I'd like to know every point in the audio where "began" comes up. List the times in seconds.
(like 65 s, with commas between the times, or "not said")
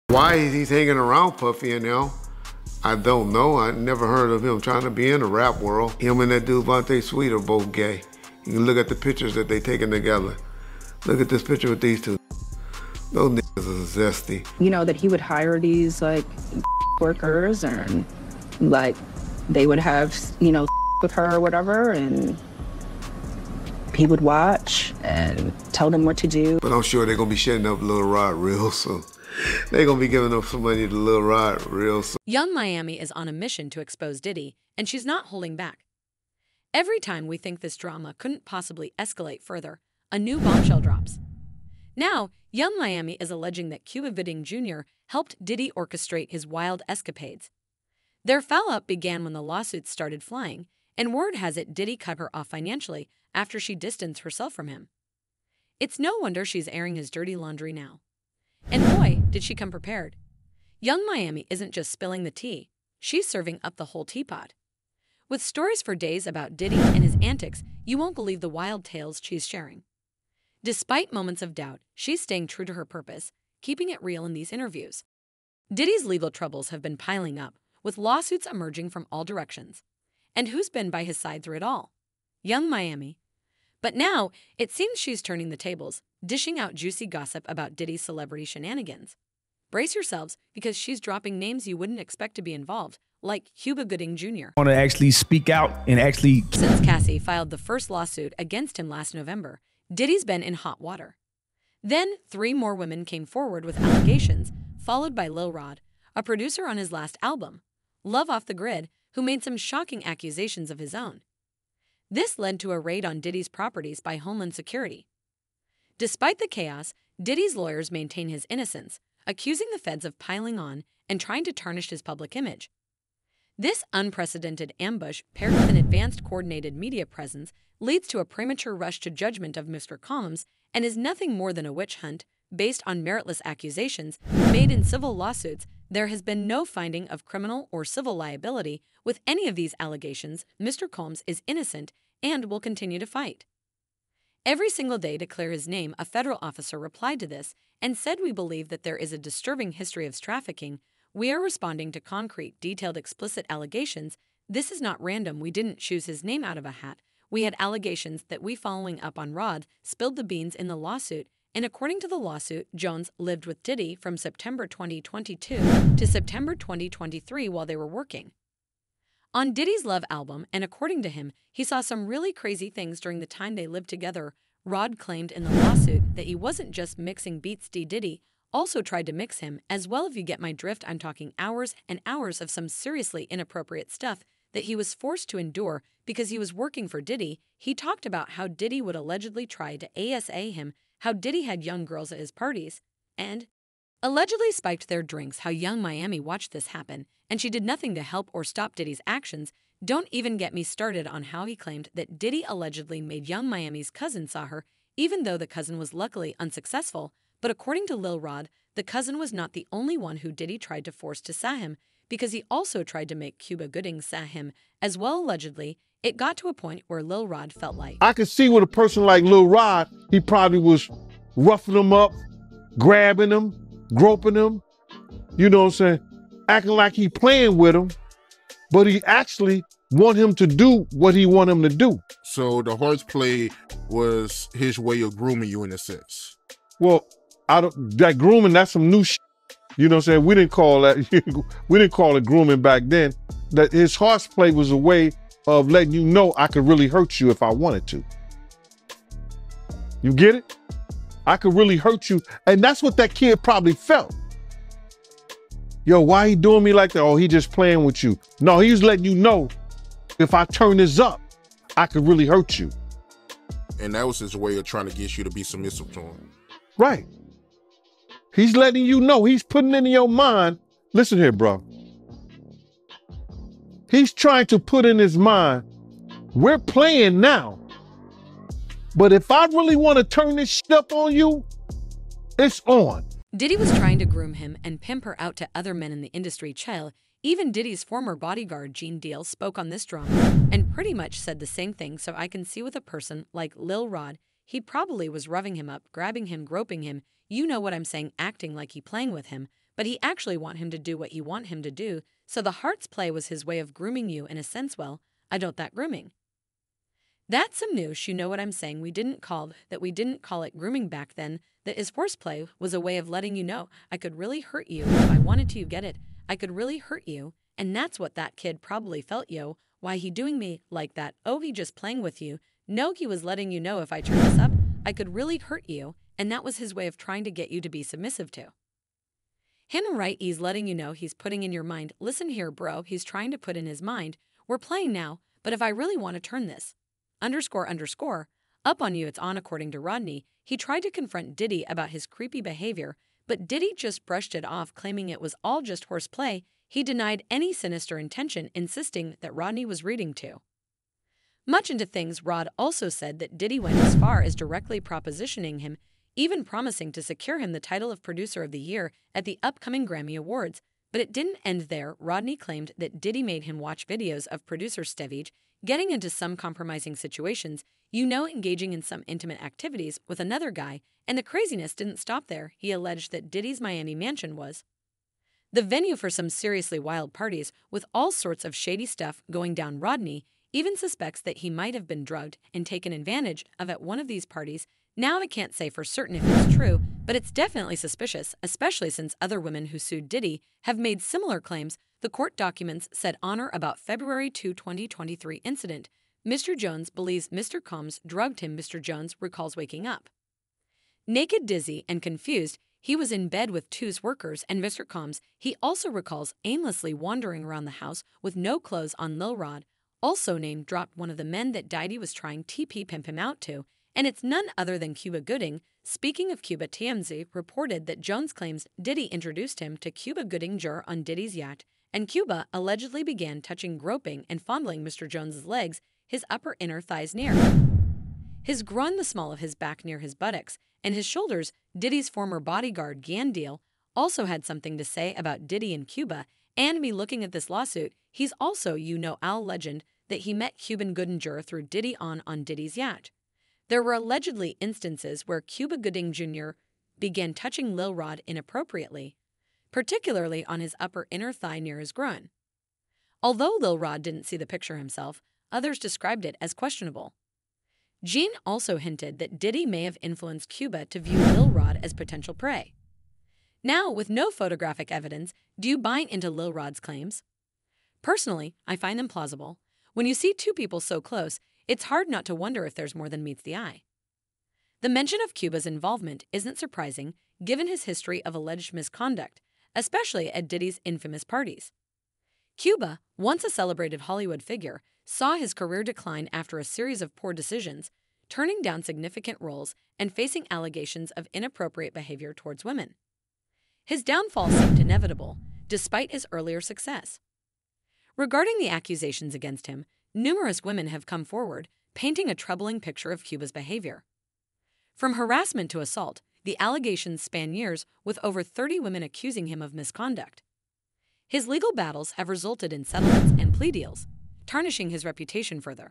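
48 s, 423 s, 446 s.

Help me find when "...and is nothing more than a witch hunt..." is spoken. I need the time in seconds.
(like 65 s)
130 s.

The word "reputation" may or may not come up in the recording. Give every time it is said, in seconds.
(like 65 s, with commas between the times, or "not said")
515 s.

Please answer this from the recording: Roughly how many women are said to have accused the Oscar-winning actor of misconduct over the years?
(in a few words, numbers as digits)
over 30.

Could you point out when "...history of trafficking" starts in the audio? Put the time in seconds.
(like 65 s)
149 s.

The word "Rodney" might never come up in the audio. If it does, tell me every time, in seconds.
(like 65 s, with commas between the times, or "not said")
339 s, 349 s, 361 s, 379 s.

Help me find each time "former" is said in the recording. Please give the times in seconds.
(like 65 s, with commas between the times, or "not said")
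287 s, 432 s.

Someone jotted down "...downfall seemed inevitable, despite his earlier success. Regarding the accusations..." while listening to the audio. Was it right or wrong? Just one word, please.
right.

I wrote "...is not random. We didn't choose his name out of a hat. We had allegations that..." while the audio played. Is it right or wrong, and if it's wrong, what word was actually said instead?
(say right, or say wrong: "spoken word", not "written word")
right.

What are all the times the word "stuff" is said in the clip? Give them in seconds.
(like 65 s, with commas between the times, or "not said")
183 s, 378 s.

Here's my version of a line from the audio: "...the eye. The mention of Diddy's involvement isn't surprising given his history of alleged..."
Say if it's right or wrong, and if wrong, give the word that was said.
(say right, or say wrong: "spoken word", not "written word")
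wrong: "Cuba", not "Diddy".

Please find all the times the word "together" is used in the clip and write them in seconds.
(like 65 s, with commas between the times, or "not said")
9 s, 173 s.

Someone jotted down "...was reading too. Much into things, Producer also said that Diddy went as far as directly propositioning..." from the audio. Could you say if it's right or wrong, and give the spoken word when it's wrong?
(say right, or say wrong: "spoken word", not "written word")
wrong: "Rod", not "Producer".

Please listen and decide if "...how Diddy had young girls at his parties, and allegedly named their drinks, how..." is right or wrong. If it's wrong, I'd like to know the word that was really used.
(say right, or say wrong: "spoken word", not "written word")
wrong: "spiked", not "named".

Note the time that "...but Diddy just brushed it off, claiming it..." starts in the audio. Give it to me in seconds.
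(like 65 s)
343 s.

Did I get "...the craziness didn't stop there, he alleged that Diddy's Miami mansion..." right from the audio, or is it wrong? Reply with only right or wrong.
right.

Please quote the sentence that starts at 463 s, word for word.
Now, with no photographic evidence, do you buy into Lil Rod's claims?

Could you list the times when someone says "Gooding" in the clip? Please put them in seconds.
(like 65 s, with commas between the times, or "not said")
44 s, 93 s, 213 s, 415 s, 420 s, 440 s, 445 s.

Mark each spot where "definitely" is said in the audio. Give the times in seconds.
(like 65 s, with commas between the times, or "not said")
387 s.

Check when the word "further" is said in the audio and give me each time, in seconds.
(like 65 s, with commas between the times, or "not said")
39 s, 515 s.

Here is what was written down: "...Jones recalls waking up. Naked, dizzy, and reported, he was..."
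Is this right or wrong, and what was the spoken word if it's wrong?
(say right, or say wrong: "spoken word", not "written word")
wrong: "confused", not "reported".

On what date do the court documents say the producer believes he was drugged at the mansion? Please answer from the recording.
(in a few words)
February 2, 2023.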